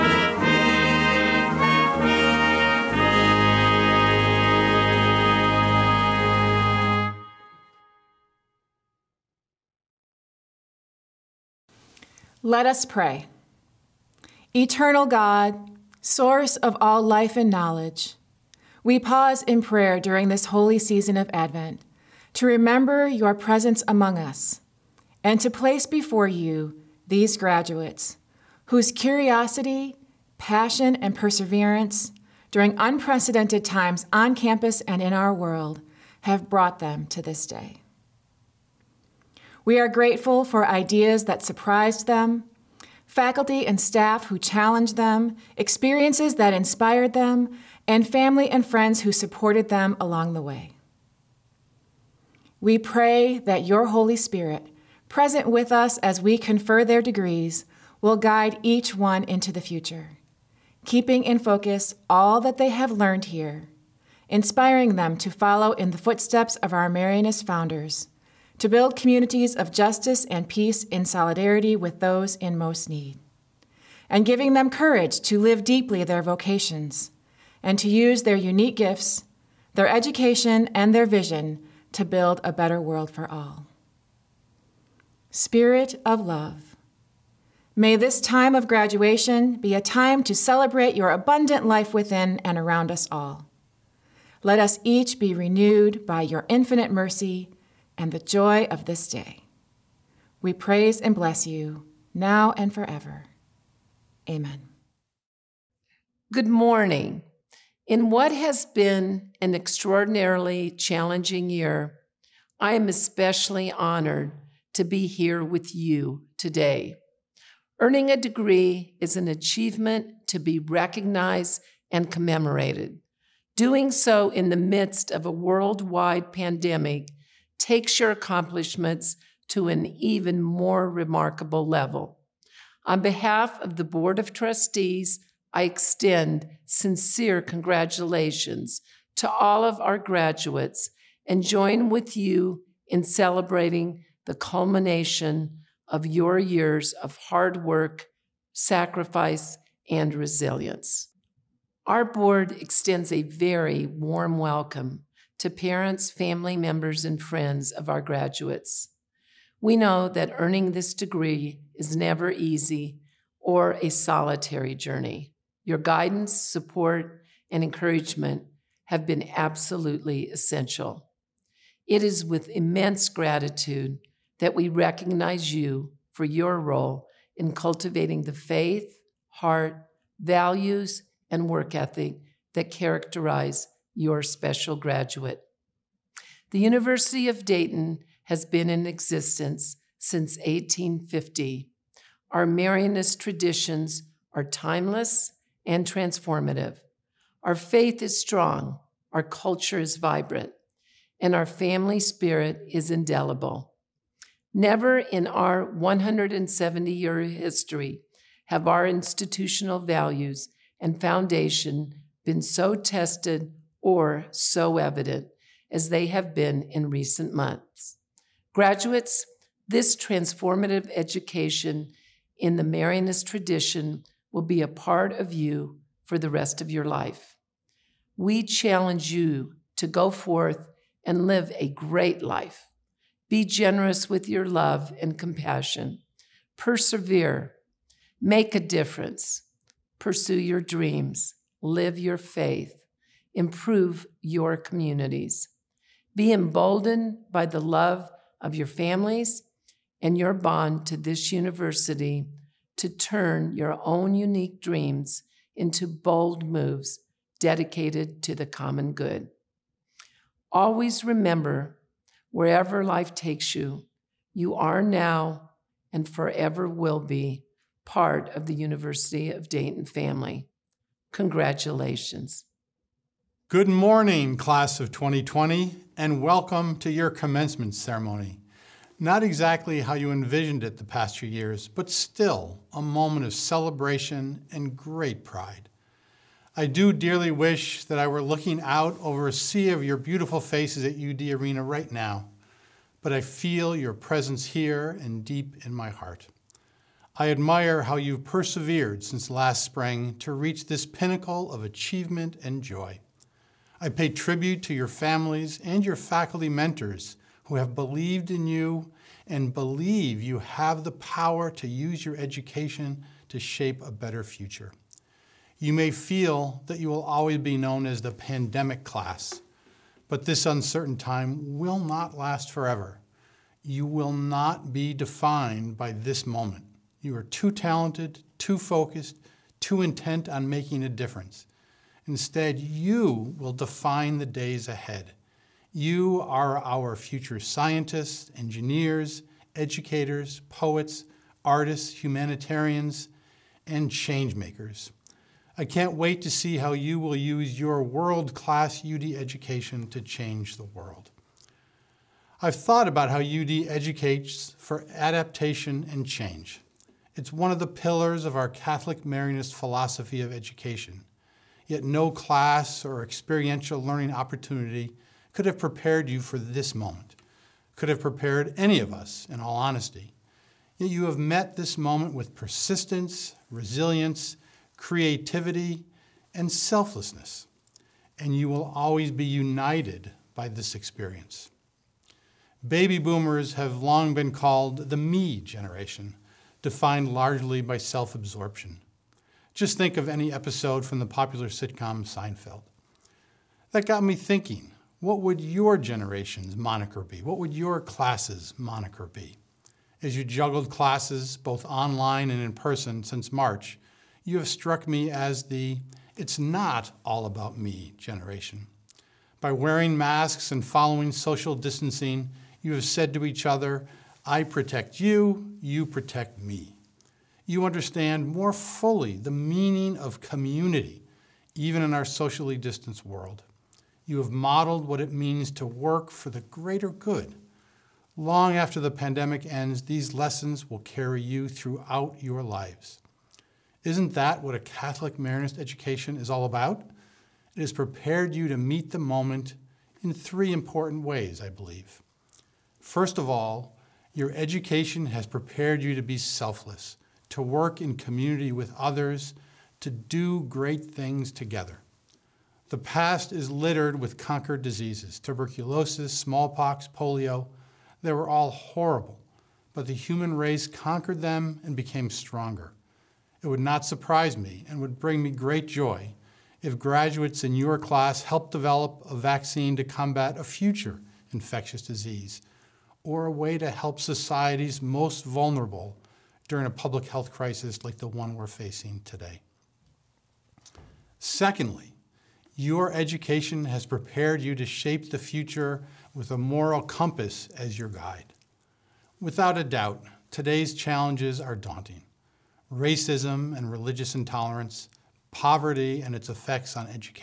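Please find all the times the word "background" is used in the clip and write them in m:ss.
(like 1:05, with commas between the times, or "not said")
not said.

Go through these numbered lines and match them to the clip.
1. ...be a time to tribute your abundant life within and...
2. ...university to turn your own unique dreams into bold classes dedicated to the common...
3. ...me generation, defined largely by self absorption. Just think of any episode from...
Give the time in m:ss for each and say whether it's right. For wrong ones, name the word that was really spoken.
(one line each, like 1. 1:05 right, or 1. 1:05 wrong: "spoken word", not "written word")
1. 1:29 wrong: "celebrate", not "tribute"
2. 4:11 wrong: "moves", not "classes"
3. 6:24 right.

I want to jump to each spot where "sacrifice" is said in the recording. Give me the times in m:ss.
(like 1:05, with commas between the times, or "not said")
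2:28.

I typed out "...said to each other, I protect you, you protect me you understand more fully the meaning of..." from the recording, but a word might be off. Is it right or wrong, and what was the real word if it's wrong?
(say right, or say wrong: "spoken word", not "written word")
right.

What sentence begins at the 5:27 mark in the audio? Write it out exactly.
You are too talented, too focused, too intent on making a difference.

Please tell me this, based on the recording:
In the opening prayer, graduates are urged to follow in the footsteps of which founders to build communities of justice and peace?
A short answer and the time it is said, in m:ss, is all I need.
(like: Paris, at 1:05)
Marianist founders, at 1:06.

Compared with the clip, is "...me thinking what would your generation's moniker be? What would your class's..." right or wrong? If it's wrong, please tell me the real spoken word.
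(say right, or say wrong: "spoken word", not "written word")
right.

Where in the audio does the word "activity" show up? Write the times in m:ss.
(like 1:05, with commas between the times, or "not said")
not said.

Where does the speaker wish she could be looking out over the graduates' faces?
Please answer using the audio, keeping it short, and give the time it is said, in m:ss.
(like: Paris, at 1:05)
UD Arena, at 4:51.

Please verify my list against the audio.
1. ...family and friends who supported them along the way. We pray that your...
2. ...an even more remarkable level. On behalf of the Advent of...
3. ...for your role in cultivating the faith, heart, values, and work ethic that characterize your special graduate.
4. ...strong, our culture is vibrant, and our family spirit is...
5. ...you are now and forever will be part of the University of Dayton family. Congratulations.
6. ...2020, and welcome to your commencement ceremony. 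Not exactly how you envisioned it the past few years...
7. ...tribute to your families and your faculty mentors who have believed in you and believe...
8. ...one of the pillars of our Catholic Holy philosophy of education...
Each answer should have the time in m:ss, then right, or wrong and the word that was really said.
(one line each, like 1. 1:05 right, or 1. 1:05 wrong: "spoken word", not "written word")
1. 0:48 right
2. 2:09 wrong: "Board", not "Advent"
3. 2:56 right
4. 3:18 right
5. 4:24 right
6. 4:34 right
7. 5:04 right
8. 5:57 wrong: "Marianist", not "Holy".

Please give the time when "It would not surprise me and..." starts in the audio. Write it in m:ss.
7:43.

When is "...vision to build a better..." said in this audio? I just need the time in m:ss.
1:21.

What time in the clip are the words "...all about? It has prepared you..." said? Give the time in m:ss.
7:16.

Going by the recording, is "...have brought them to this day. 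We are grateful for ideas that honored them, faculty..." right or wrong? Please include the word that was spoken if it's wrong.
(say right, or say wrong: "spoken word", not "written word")
wrong: "surprised", not "honored".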